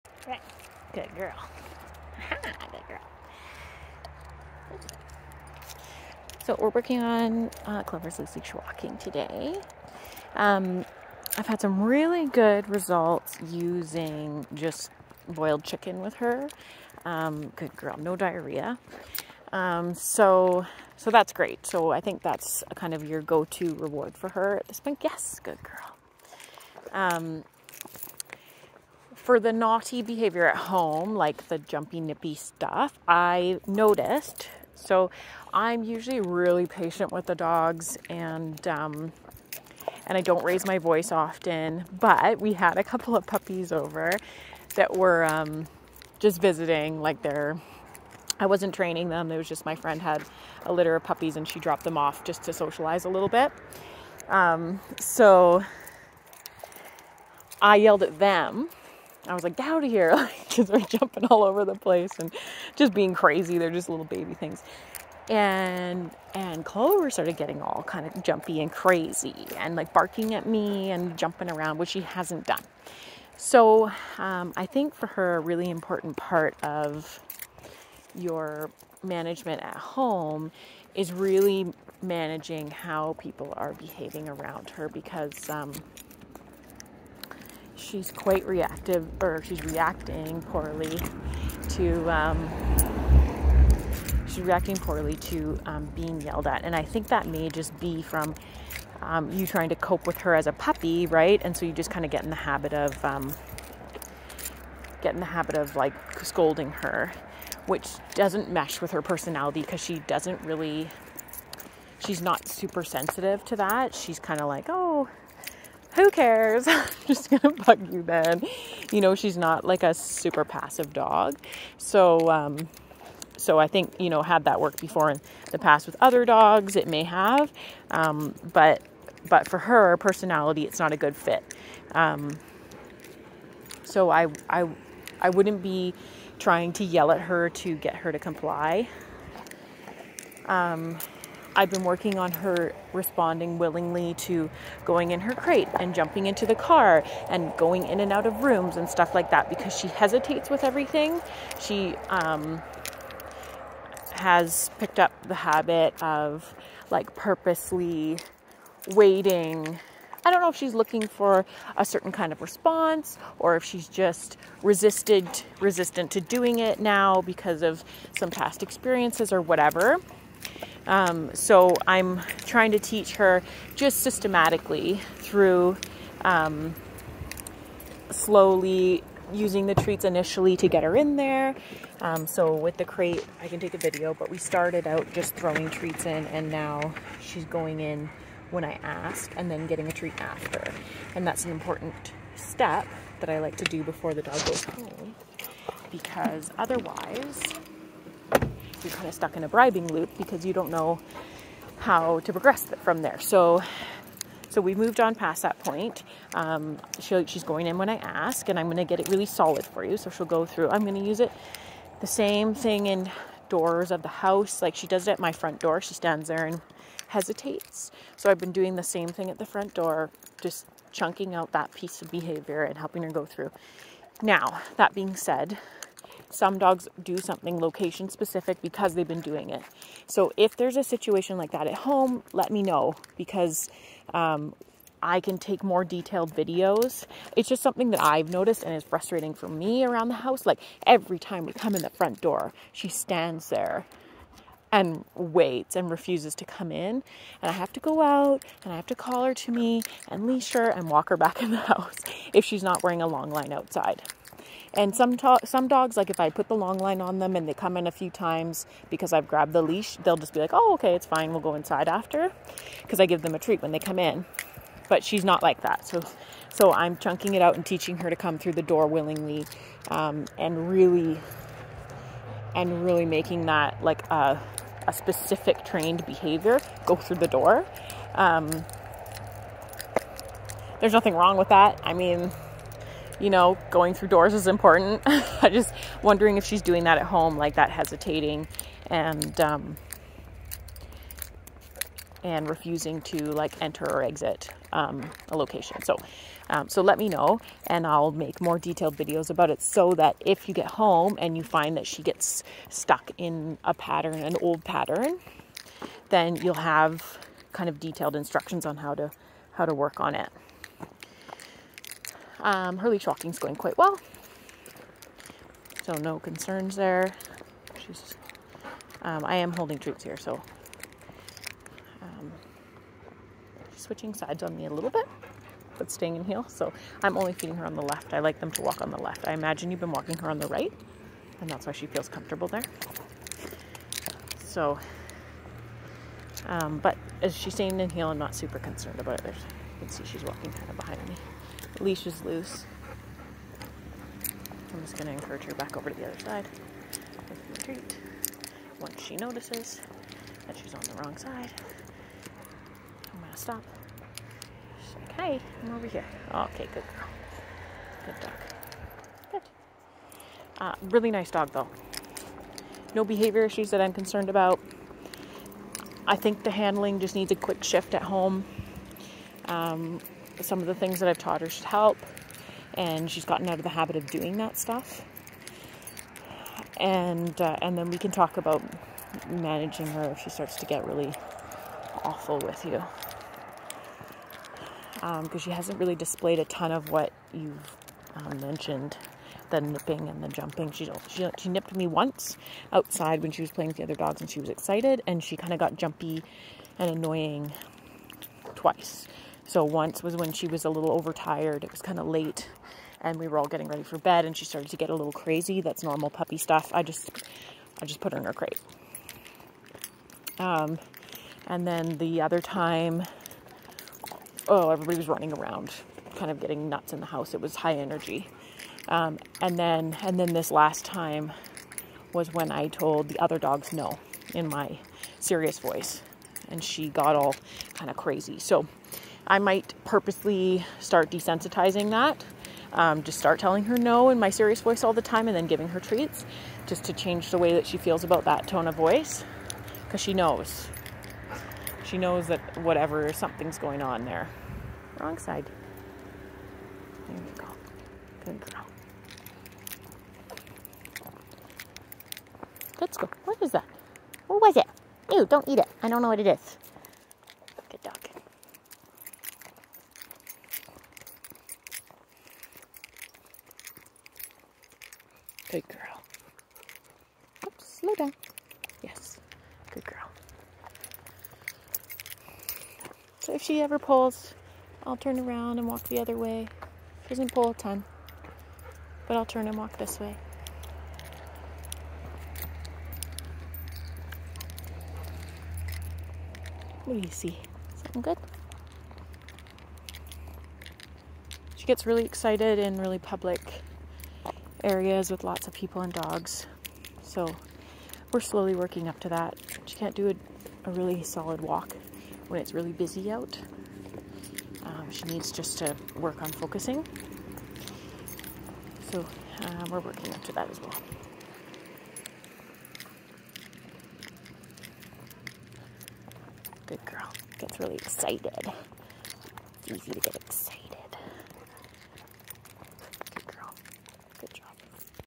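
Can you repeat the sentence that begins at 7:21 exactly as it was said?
She knows that whatever, something's going on there.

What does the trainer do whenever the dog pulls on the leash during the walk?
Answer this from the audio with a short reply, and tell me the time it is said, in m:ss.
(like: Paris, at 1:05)
Turn around, at 7:54.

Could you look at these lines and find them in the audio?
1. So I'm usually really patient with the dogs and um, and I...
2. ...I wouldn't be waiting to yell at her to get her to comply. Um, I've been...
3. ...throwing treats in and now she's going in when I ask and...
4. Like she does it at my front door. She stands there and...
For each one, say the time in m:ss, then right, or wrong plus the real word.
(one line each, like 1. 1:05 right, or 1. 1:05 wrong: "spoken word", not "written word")
1. 0:34 right
2. 2:15 wrong: "trying", not "waiting"
3. 3:05 right
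4. 3:34 right.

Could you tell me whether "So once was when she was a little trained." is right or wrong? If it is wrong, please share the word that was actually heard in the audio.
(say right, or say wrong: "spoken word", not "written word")
wrong: "overtired", not "trained".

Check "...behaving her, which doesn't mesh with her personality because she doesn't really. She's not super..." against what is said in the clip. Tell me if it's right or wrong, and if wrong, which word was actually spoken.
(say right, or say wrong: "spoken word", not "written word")
wrong: "scolding", not "behaving".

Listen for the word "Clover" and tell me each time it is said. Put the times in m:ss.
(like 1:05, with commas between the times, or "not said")
0:07, 1:06.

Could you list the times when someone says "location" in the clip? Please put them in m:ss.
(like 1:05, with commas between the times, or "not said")
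3:47, 4:55.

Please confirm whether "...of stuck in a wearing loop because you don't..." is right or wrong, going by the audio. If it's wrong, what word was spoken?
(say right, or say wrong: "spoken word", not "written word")
wrong: "bribing", not "wearing".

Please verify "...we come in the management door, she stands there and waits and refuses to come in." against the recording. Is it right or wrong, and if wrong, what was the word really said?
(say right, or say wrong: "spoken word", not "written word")
wrong: "front", not "management".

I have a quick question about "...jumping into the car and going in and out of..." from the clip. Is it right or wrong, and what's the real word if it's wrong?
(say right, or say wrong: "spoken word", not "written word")
right.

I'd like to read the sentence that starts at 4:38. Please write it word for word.
Um, there's nothing wrong with that.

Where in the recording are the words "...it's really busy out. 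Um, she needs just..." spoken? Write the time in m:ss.
8:22.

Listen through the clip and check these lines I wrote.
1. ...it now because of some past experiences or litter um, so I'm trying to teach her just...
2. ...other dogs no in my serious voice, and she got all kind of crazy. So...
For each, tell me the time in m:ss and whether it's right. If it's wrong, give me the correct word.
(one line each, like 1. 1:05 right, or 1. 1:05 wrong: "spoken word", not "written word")
1. 2:46 wrong: "whatever", not "litter"
2. 7:03 right.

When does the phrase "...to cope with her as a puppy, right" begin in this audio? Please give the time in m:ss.
1:39.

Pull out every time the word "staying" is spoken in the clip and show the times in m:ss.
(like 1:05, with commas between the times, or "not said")
5:25, 5:37.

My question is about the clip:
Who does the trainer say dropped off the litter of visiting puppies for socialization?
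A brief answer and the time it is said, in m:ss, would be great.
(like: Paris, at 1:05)
My friend, at 0:49.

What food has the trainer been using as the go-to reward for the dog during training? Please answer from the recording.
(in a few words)
Boiled chicken.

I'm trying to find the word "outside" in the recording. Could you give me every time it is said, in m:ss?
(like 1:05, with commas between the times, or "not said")
4:13, 6:32.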